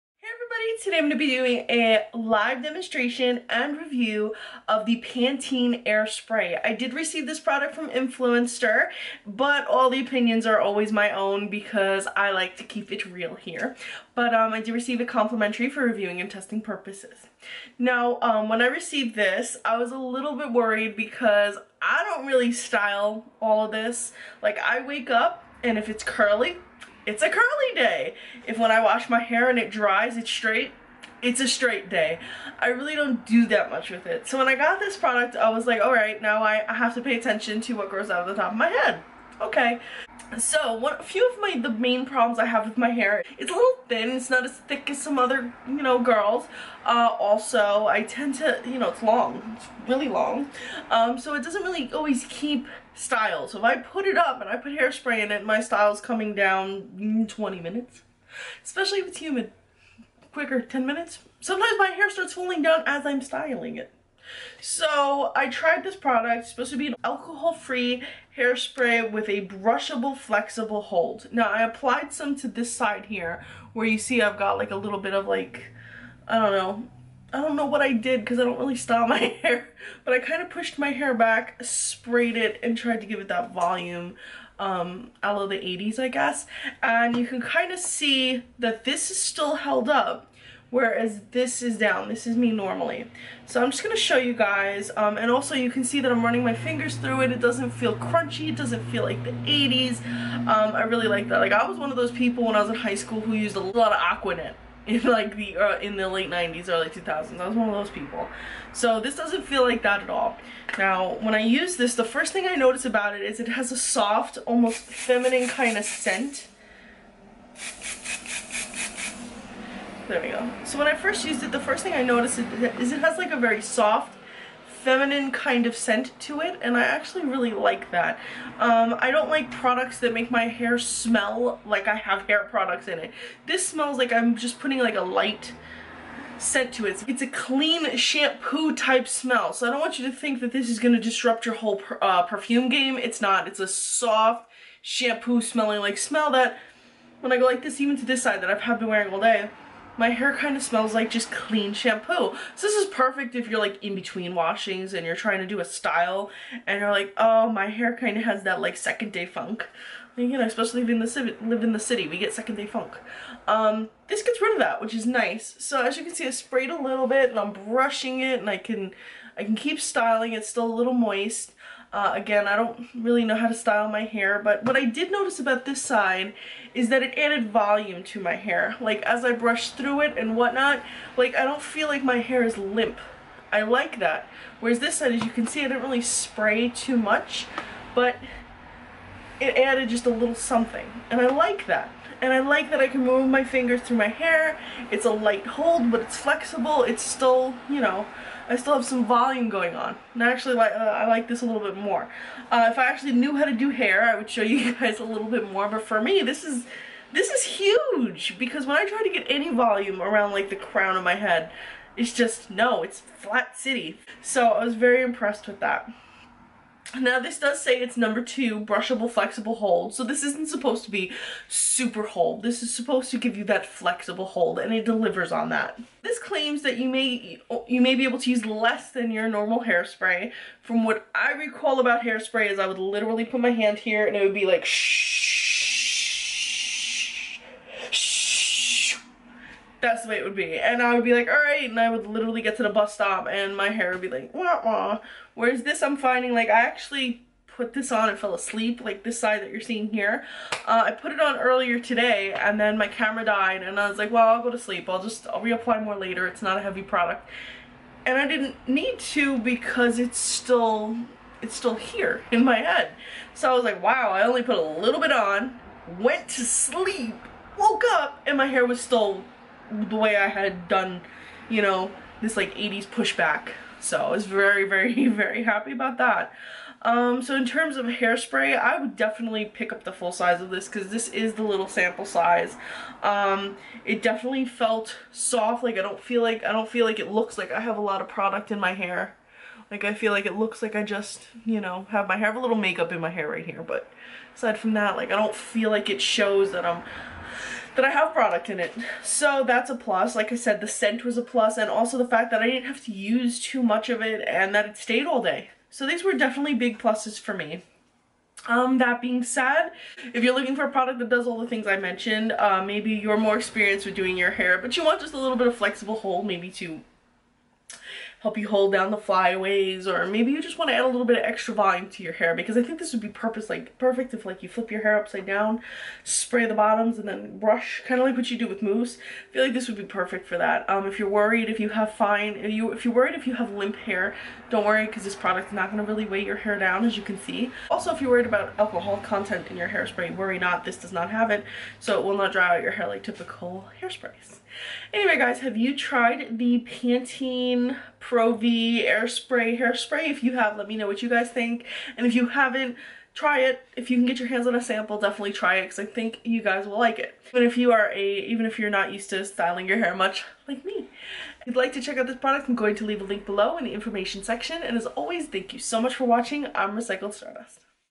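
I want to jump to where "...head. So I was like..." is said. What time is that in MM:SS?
04:22.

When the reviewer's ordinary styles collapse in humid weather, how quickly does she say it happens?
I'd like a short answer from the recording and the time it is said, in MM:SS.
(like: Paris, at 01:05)
10 minutes, at 01:00.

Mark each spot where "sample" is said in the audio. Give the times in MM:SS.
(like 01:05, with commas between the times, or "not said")
04:41, 05:54.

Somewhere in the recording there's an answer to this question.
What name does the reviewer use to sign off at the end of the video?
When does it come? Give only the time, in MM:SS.
06:06.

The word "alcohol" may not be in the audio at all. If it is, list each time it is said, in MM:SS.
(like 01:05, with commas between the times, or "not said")
01:07, 05:38.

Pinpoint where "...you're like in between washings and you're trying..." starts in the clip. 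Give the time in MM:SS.
02:33.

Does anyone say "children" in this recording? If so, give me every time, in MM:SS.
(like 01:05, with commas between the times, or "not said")
not said.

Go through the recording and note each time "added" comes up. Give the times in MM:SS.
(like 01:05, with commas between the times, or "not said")
02:57, 03:09.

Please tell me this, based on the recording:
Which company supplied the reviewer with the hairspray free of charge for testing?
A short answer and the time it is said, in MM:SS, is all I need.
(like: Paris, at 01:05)
Influenster, at 00:07.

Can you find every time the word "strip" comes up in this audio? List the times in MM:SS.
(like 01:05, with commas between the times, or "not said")
not said.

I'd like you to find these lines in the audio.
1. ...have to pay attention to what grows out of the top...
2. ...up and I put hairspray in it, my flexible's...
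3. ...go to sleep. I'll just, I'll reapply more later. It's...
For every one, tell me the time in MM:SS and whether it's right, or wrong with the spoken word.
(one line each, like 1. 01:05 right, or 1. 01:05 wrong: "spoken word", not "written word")
1. 00:36 right
2. 00:54 wrong: "style", not "flexible"
3. 04:14 right.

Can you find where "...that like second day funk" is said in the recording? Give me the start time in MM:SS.
02:38.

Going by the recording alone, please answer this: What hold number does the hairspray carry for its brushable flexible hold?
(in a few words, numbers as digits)
2.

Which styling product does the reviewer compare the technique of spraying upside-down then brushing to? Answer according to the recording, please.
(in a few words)
mousse.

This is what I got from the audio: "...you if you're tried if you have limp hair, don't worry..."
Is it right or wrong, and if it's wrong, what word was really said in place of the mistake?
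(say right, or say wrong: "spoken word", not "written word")
wrong: "worried", not "tried".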